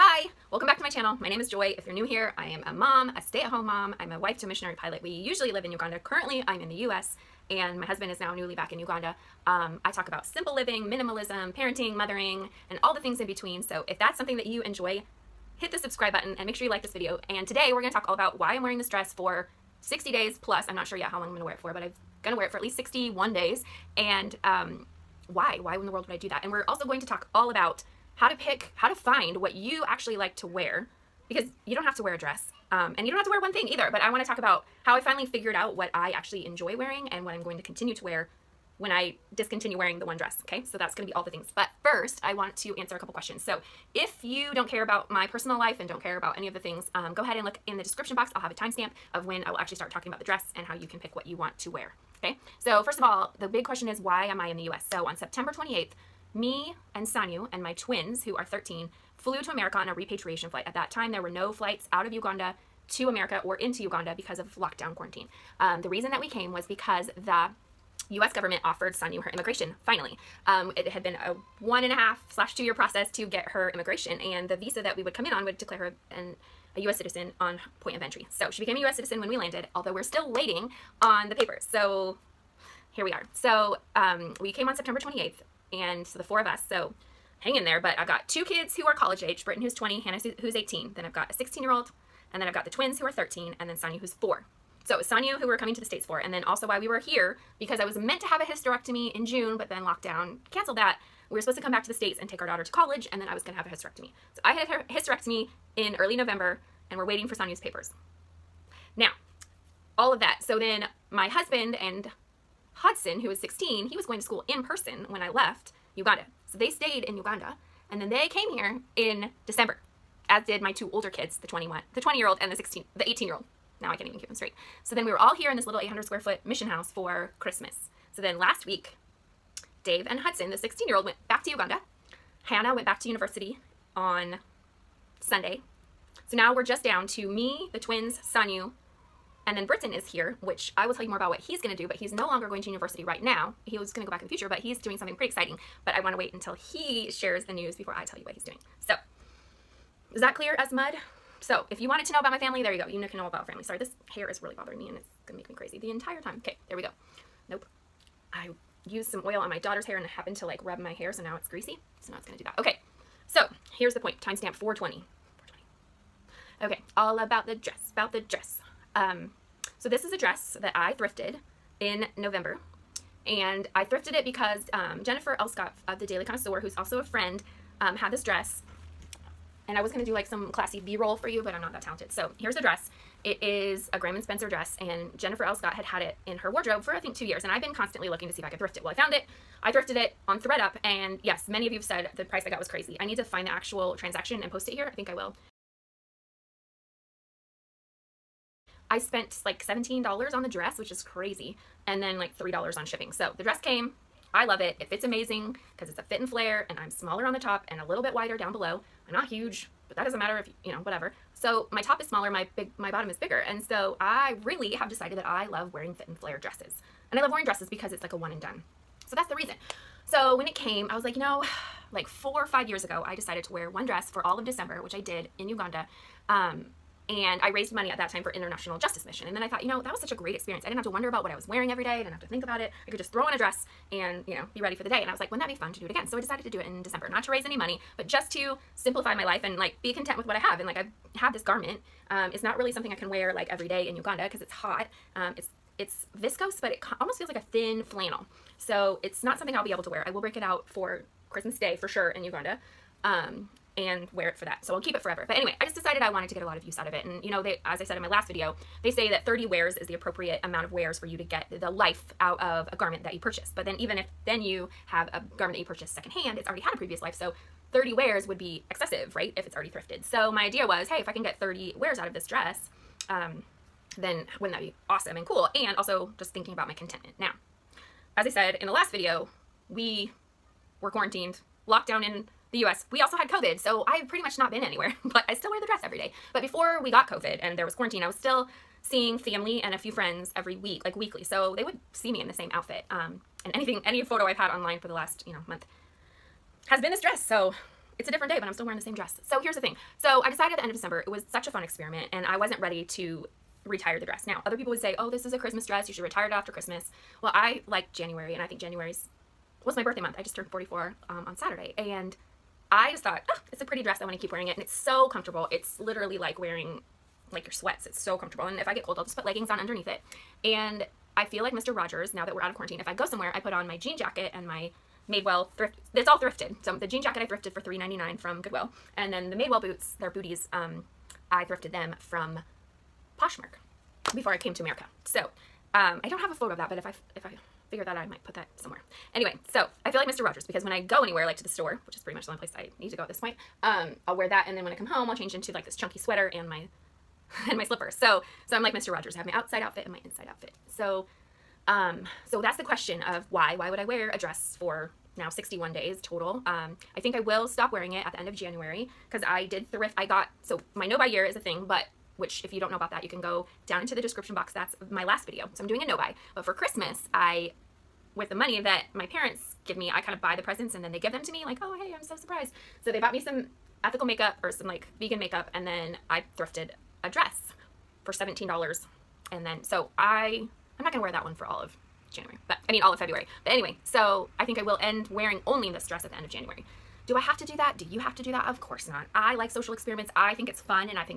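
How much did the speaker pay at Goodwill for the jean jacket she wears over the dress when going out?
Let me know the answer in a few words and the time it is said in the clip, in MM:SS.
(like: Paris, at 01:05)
$3.99, at 05:27.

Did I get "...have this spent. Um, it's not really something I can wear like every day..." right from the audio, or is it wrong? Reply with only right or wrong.
wrong.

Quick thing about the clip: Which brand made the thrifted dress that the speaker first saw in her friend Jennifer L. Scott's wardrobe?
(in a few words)
Graham and Spencer.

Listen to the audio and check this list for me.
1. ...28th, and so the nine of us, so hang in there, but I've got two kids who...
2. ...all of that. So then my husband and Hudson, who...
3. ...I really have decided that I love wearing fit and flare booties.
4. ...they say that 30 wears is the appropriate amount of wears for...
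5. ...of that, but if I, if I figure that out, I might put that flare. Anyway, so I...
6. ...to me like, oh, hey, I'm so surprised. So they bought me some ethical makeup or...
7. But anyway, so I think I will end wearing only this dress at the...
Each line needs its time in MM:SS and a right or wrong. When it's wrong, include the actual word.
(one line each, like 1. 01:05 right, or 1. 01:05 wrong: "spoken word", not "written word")
1. 01:24 wrong: "four", not "nine"
2. 01:49 right
3. 03:33 wrong: "dresses", not "booties"
4. 04:18 right
5. 05:36 wrong: "somewhere", not "flare"
6. 06:11 right
7. 06:23 right.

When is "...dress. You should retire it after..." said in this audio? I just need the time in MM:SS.
05:05.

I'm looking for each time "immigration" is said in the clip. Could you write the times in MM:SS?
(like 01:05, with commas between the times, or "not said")
01:09, 01:13.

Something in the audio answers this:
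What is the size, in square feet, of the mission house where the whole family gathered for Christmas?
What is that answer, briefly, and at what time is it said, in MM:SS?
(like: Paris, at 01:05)
800, at 02:05.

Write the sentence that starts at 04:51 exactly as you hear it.
So they would see me in the same outfit.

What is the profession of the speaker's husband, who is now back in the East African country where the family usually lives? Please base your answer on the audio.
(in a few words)
Missionary pilot.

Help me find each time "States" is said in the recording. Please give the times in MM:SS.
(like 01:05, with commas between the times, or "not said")
01:35, 01:41.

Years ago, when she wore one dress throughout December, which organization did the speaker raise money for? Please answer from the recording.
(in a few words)
International Justice Mission.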